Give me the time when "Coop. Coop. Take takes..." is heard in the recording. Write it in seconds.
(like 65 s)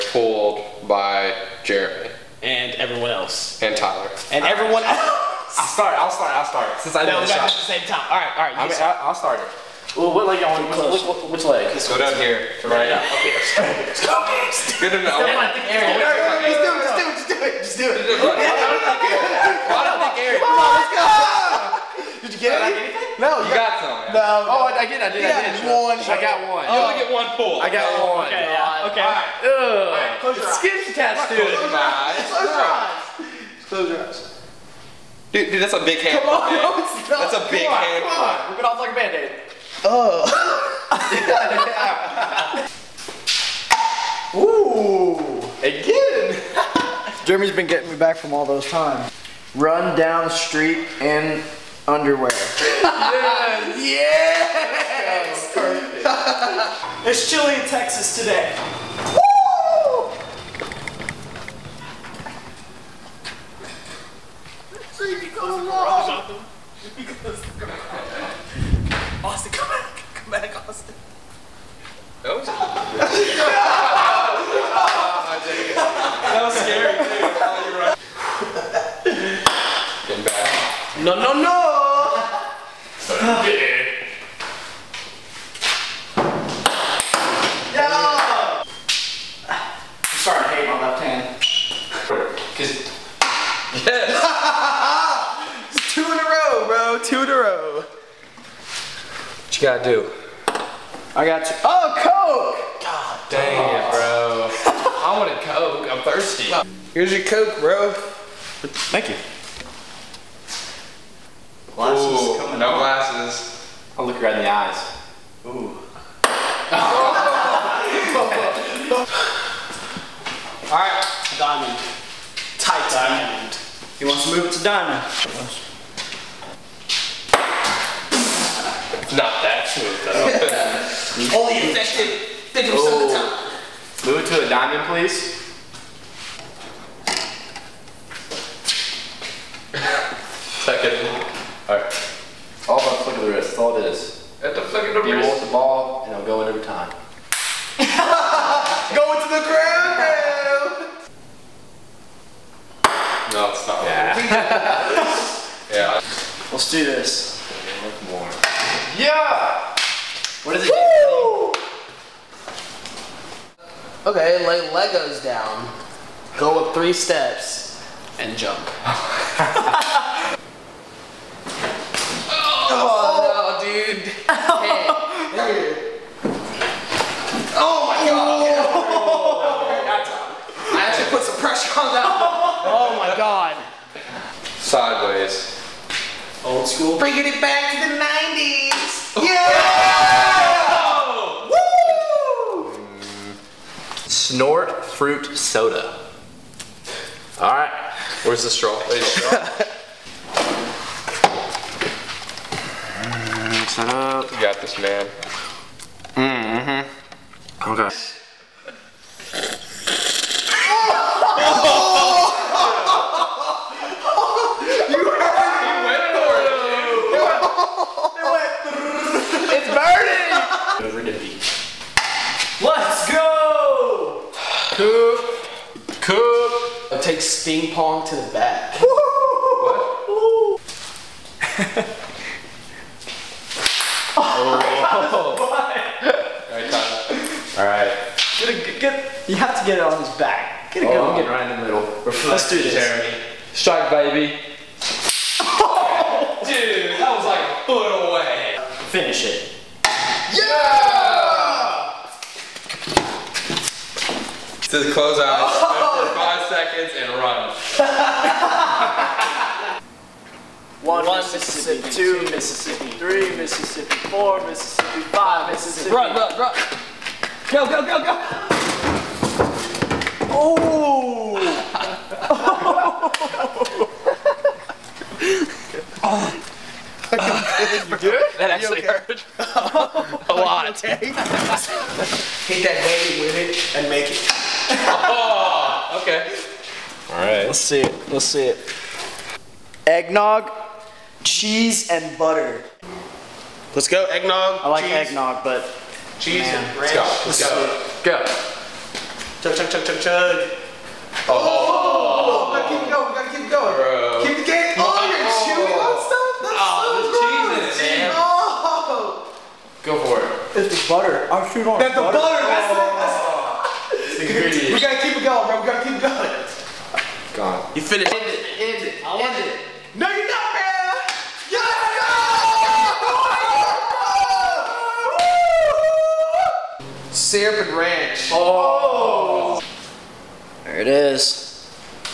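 224 s.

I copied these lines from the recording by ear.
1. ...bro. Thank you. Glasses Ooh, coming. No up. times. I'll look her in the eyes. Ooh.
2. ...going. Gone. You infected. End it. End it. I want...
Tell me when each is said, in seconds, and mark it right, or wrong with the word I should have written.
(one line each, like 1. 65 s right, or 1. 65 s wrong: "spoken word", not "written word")
1. 107 s wrong: "glasses", not "times"
2. 316 s wrong: "finished", not "infected".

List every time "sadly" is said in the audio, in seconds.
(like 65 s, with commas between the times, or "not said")
not said.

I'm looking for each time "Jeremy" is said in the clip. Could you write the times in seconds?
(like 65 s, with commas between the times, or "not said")
1 s, 47 s, 242 s.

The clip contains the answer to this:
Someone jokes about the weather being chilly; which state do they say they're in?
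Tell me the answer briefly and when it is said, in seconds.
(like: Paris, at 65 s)
Texas, at 57 s.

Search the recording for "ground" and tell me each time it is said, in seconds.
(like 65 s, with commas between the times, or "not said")
149 s.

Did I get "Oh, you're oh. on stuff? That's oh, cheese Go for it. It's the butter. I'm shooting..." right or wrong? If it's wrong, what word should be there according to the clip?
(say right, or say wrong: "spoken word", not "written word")
right.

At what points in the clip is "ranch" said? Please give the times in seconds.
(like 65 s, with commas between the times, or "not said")
296 s, 327 s.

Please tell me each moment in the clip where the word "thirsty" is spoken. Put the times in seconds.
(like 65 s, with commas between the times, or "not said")
106 s.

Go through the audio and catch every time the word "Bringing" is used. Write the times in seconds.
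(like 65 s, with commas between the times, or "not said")
186 s.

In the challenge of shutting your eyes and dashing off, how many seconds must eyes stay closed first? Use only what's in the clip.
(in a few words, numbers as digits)
5.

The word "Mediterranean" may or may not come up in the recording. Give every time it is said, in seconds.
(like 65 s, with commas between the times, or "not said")
not said.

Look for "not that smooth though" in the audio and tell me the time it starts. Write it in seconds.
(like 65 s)
129 s.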